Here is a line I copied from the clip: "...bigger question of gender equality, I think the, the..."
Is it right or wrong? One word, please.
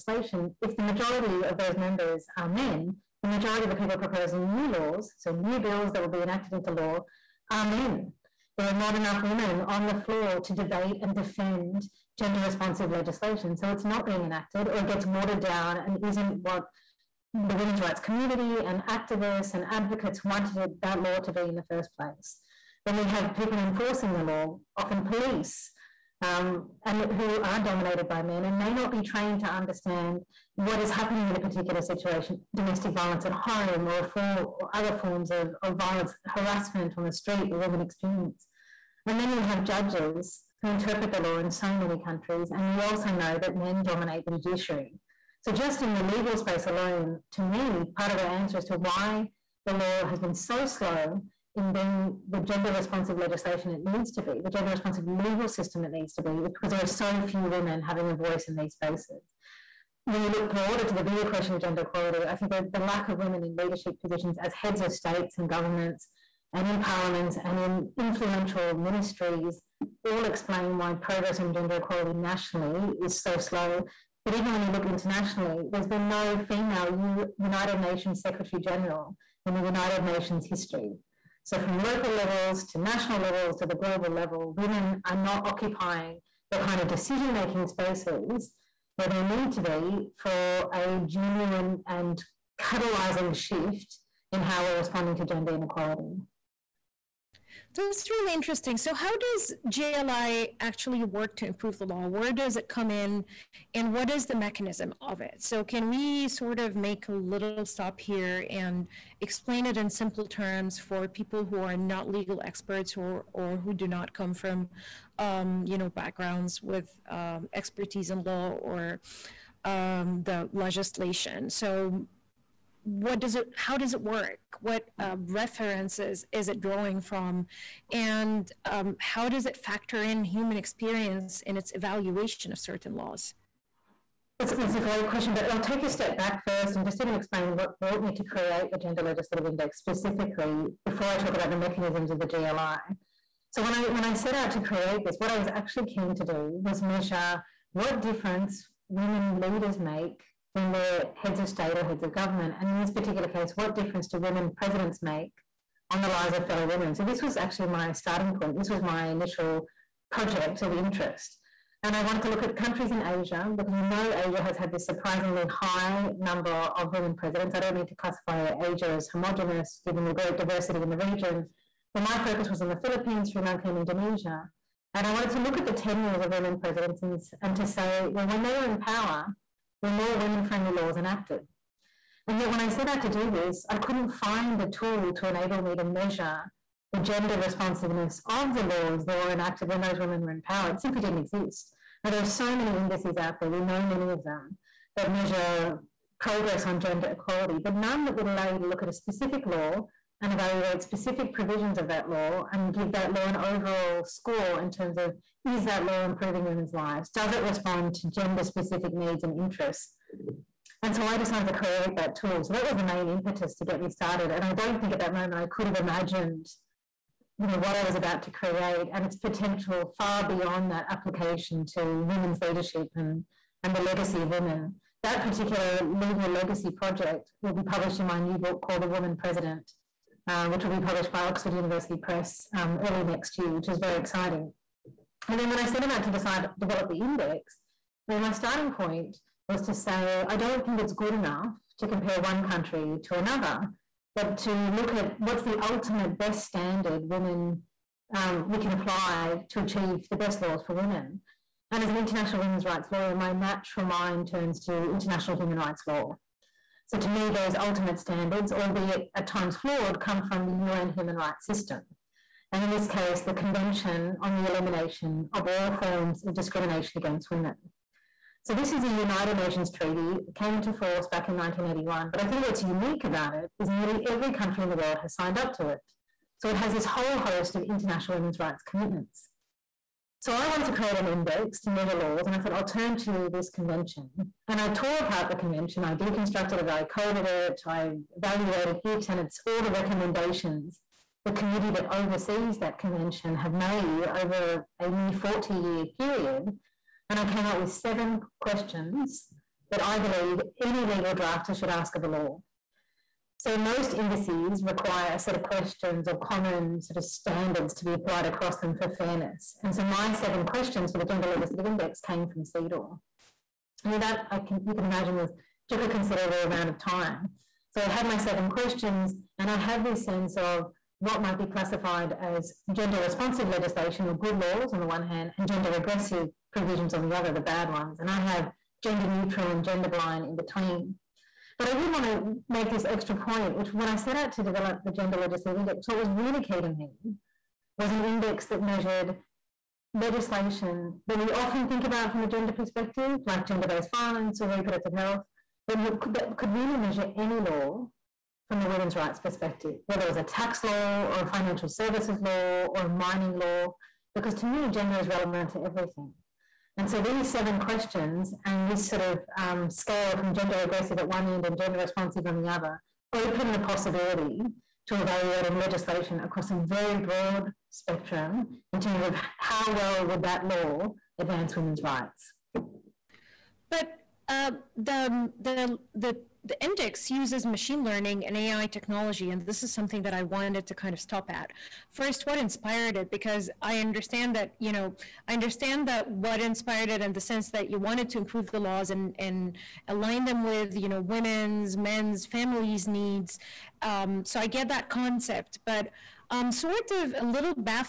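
right.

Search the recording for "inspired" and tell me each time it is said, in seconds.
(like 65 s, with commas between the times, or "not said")
382 s, 386 s.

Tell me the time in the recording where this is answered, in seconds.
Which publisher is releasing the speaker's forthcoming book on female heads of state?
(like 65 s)
231 s.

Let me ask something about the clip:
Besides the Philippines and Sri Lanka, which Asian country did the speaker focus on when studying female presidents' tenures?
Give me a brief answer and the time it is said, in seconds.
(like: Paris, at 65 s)
Indonesia, at 173 s.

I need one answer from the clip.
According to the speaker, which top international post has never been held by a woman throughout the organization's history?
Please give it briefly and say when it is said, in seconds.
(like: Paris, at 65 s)
United Nations Secretary General, at 77 s.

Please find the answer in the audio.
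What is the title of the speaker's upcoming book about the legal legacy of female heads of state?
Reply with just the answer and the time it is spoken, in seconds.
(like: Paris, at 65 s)
The Woman President, at 228 s.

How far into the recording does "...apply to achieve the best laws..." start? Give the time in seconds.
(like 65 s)
248 s.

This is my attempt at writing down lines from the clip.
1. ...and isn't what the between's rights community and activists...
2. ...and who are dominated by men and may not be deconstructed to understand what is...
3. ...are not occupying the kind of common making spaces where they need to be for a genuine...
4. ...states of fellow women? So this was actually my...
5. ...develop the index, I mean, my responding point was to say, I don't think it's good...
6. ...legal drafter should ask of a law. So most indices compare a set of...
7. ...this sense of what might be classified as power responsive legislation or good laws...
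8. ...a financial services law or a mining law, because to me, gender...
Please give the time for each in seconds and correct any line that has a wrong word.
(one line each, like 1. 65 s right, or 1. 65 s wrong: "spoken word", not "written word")
1. 15 s wrong: "women", not "between"
2. 26 s wrong: "trained", not "deconstructed"
3. 85 s wrong: "decision", not "common"
4. 156 s wrong: "lives", not "states"
5. 236 s wrong: "starting", not "responding"
6. 300 s wrong: "require", not "compare"
7. 319 s wrong: "gender", not "power"
8. 351 s right.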